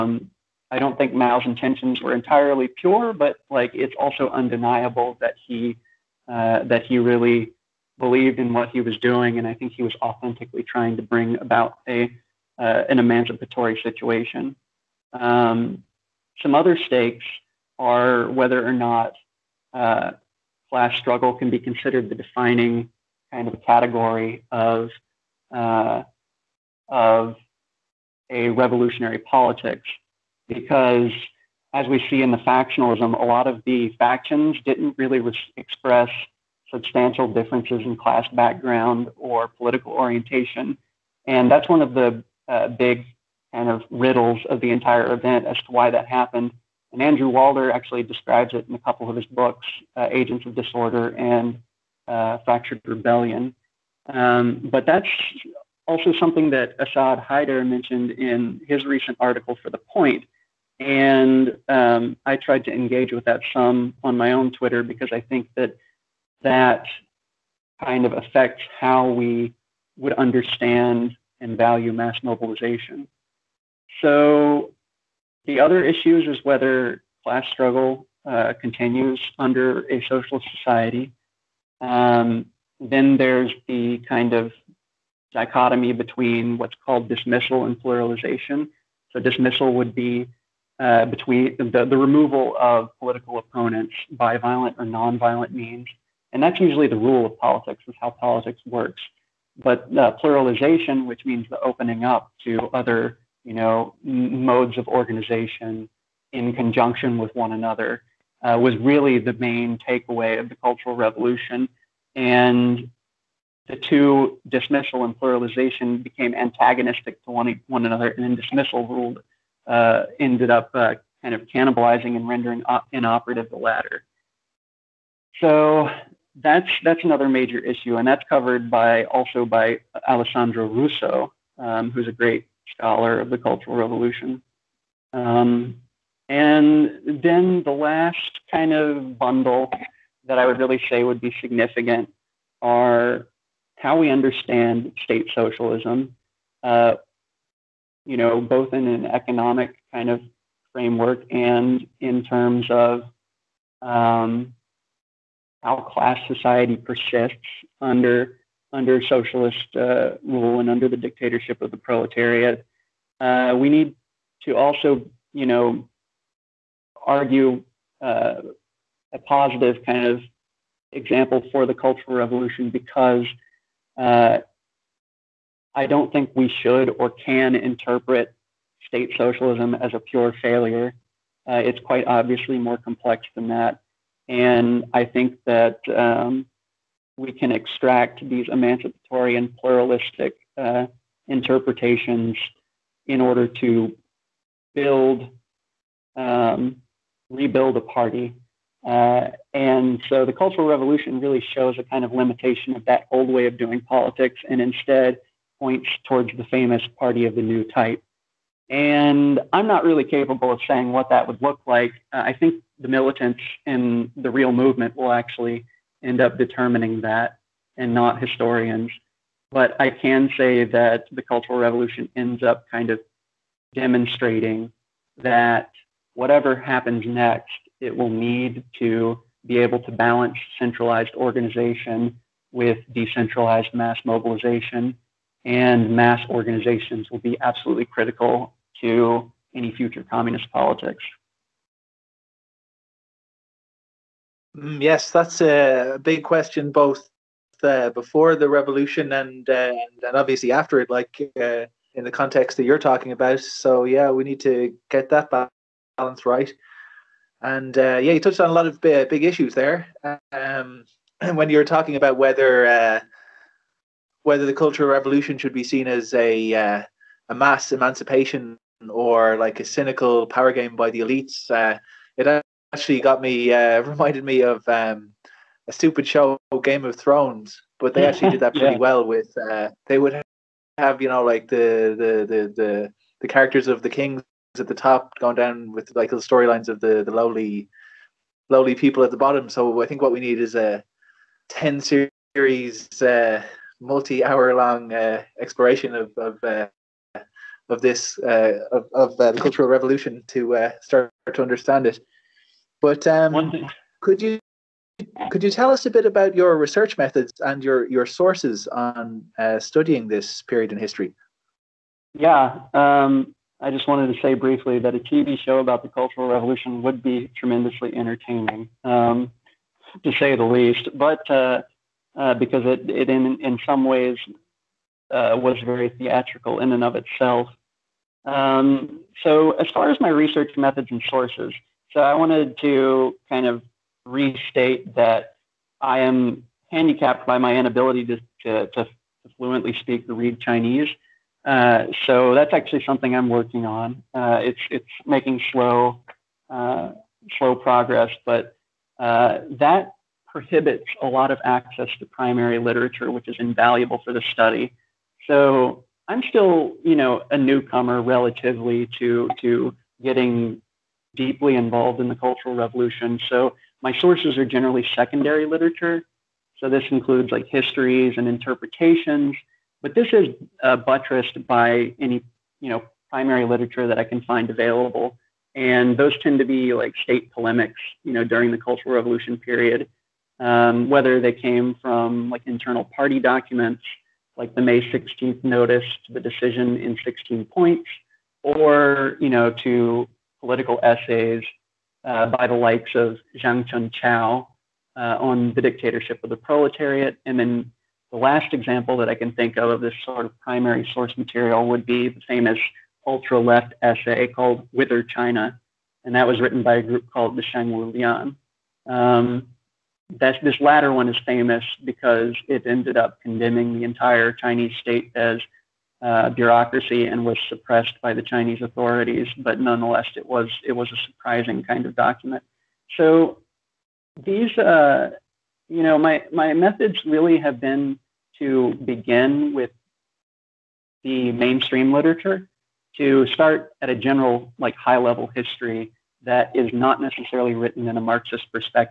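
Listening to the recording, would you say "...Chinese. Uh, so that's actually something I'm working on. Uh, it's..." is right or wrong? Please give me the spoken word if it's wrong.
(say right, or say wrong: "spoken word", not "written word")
right.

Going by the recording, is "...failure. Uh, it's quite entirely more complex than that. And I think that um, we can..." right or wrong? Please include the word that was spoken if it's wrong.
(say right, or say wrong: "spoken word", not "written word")
wrong: "obviously", not "entirely".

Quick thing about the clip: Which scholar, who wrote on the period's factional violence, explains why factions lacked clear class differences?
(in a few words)
Andrew Walder.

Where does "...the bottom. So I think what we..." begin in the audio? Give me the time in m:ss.
4:49.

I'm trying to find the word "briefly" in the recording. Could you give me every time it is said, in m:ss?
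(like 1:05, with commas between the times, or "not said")
5:14.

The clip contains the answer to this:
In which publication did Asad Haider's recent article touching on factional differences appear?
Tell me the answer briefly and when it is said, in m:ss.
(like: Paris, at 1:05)
The Point, at 0:59.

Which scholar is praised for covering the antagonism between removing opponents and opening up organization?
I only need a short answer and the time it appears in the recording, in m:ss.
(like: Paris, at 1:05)
Alessandro Russo, at 2:10.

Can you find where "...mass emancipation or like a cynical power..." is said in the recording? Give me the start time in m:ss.
4:27.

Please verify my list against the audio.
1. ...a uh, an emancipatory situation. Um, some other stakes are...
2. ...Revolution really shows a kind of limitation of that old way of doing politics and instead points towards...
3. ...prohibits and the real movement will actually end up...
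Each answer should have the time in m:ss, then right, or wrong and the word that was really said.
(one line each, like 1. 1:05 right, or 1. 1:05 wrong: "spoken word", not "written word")
1. 0:11 right
2. 3:20 right
3. 3:32 wrong: "militants", not "prohibits".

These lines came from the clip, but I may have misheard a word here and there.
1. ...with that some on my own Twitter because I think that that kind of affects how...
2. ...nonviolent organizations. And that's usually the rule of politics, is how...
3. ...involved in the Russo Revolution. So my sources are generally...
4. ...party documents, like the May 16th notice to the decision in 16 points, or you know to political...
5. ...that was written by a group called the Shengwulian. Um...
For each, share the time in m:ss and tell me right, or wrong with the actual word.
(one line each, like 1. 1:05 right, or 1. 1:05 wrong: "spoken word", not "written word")
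1. 1:03 right
2. 1:34 wrong: "means", not "organizations"
3. 6:01 wrong: "Cultural", not "Russo"
4. 6:22 right
5. 6:46 right.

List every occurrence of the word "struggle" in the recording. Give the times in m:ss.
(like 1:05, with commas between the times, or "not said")
0:20, 1:17.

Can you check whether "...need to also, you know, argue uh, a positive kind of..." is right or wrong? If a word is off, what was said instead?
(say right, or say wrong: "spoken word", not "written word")
right.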